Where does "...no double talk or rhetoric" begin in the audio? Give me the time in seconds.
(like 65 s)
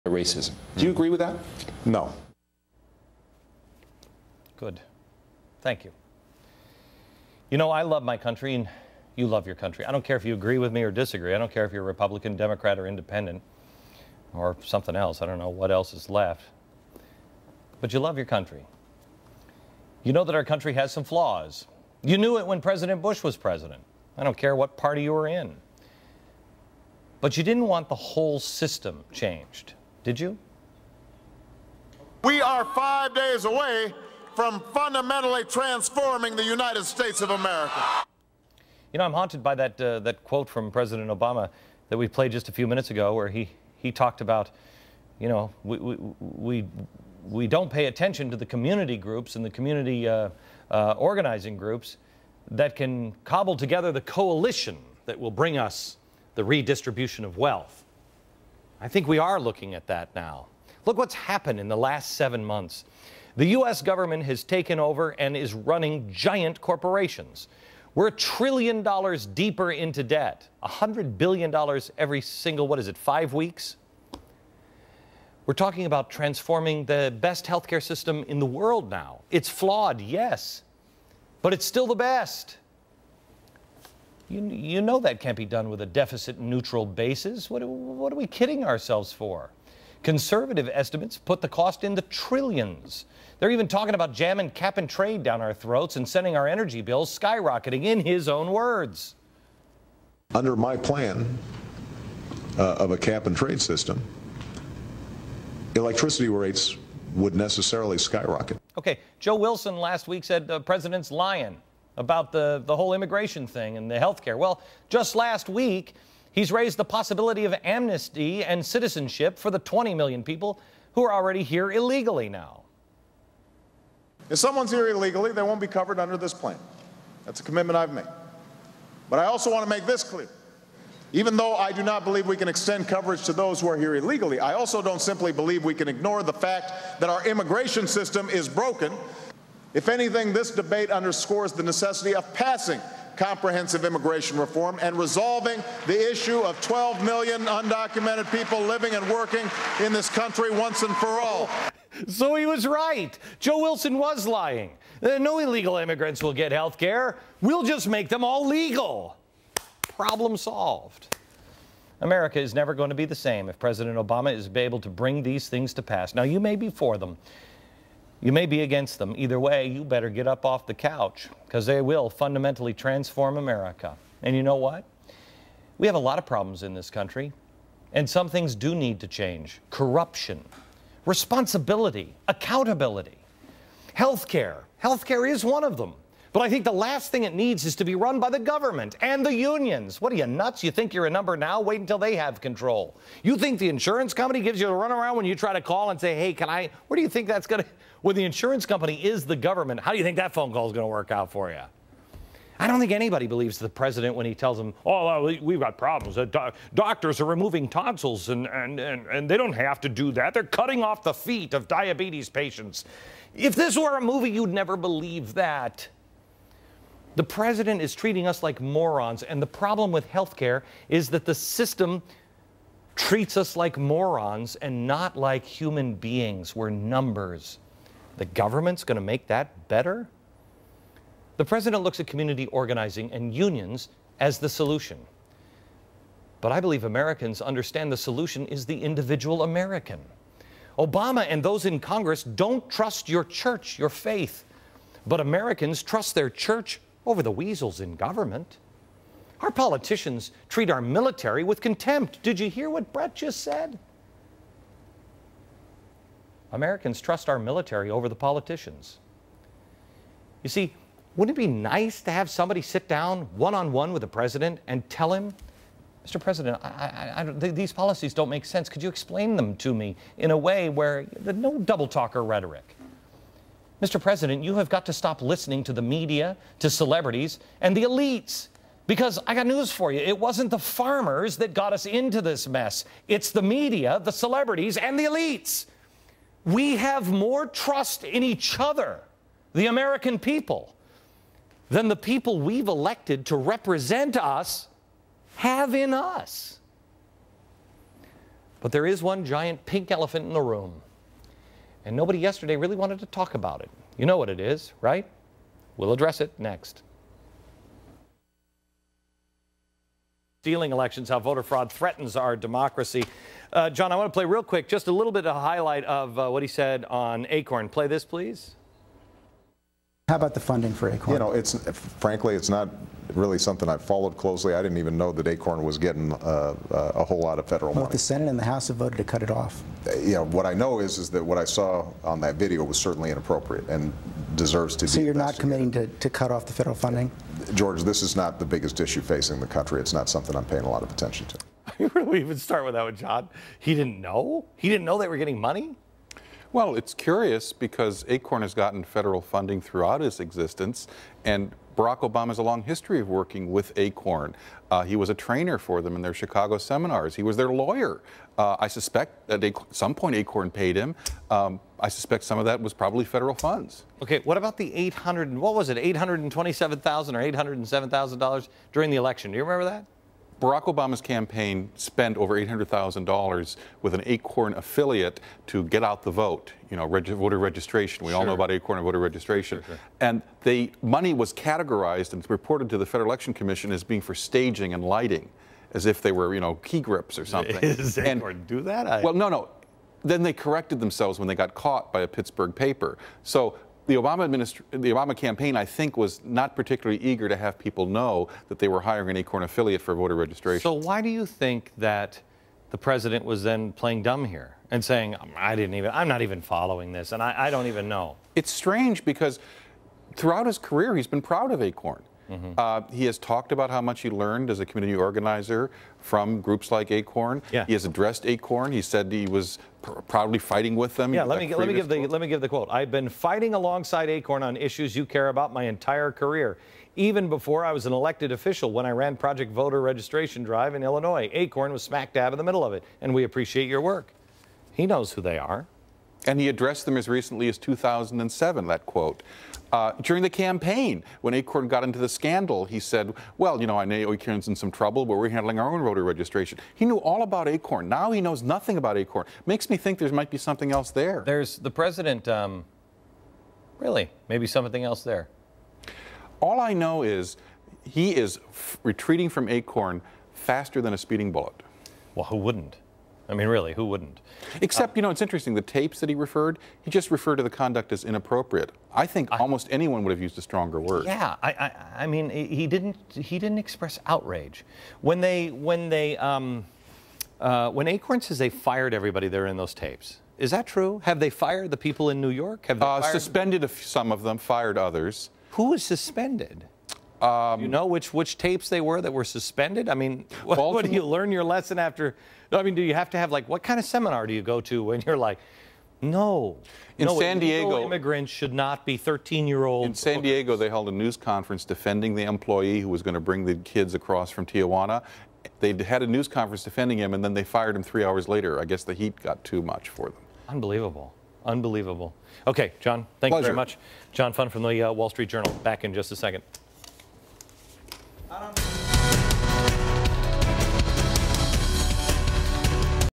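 271 s.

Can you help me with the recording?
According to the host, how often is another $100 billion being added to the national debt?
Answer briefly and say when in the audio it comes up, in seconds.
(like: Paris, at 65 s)
every 5 weeks, at 72 s.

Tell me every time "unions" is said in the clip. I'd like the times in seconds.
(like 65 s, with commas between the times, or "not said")
189 s, 233 s.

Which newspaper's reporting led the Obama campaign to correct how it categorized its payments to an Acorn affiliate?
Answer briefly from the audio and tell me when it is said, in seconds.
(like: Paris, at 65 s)
a Pittsburgh paper, at 392 s.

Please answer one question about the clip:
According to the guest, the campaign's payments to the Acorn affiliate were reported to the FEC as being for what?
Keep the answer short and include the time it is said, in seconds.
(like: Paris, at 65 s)
staging and lighting, at 384 s.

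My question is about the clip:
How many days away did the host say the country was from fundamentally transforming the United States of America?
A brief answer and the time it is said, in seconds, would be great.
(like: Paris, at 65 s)
5, at 32 s.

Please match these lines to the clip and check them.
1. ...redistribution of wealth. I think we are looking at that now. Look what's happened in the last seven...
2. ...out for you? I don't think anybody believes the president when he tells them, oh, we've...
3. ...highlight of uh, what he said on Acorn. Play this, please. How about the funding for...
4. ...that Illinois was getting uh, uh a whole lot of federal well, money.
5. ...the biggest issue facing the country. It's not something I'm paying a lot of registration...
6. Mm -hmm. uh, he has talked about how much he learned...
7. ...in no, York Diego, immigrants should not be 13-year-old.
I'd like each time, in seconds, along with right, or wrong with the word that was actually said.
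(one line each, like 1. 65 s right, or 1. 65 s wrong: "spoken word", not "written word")
1. 56 s right
2. 201 s right
3. 315 s right
4. 325 s wrong: "Acorn", not "Illinois"
5. 338 s wrong: "attention", not "registration"
6. 412 s right
7. 496 s wrong: "San", not "York".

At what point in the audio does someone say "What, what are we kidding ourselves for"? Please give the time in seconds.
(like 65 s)
87 s.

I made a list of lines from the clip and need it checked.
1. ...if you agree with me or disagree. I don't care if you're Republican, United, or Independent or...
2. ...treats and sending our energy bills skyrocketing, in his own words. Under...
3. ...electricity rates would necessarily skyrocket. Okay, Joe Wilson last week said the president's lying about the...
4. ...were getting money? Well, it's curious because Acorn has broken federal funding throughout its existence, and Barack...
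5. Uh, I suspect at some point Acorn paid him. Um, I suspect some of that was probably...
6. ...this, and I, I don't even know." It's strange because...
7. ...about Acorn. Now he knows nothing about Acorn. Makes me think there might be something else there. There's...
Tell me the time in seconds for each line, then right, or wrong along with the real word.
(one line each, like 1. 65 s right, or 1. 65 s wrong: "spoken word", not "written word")
1. 10 s wrong: "Democrat", not "United"
2. 95 s wrong: "throats", not "treats"
3. 105 s right
4. 345 s wrong: "gotten", not "broken"
5. 358 s right
6. 406 s right
7. 447 s right.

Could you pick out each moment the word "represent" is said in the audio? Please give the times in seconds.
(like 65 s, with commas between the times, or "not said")
293 s.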